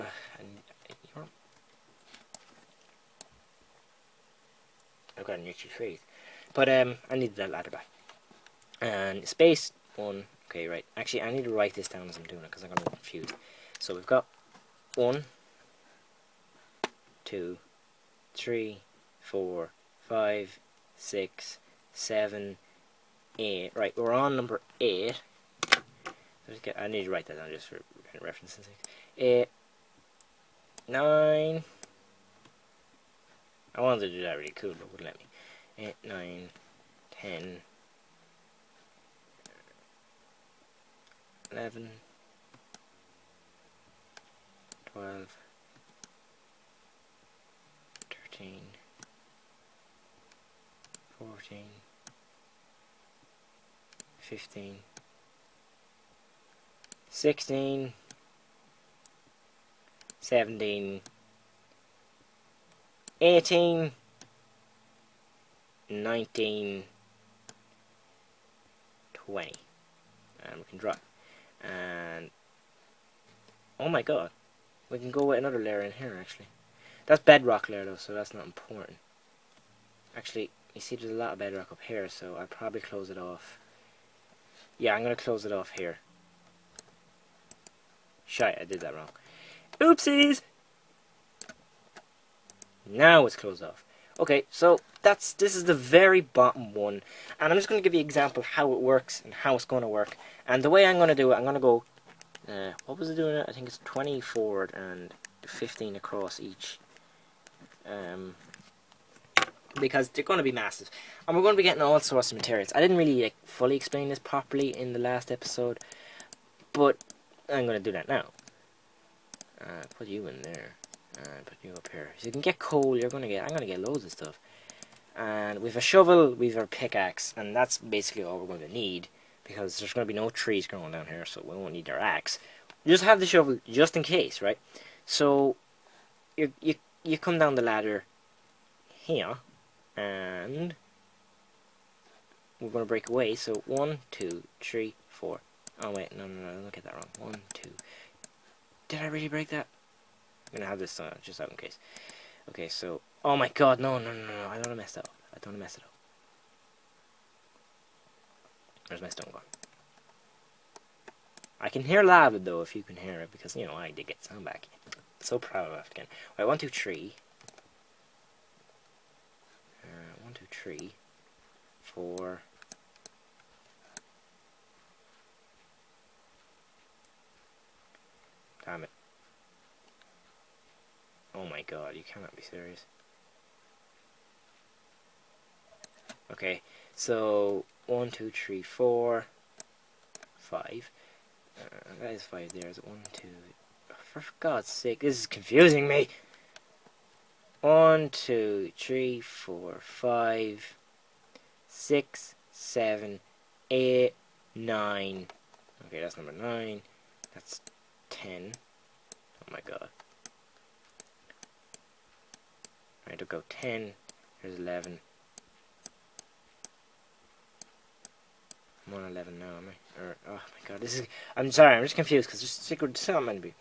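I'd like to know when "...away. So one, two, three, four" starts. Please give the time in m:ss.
2:23.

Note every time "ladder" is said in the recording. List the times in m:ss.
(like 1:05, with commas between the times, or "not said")
0:07, 2:17.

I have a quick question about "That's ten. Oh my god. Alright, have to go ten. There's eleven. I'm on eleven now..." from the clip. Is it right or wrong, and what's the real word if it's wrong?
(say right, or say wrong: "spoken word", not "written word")
right.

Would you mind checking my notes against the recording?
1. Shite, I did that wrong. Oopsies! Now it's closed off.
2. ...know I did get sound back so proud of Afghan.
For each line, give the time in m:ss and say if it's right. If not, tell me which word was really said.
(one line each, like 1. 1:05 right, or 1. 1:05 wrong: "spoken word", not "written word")
1. 1:28 right
2. 2:43 right.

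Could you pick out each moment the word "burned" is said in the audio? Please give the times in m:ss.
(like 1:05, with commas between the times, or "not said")
not said.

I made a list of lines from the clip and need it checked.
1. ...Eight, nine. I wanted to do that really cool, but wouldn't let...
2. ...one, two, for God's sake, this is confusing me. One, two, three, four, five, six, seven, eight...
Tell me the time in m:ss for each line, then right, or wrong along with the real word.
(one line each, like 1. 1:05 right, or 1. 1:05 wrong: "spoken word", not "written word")
1. 0:29 right
2. 3:12 right.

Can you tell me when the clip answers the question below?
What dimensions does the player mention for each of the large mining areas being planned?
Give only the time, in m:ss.
1:43.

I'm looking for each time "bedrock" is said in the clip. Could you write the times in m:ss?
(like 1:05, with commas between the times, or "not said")
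1:17, 1:21.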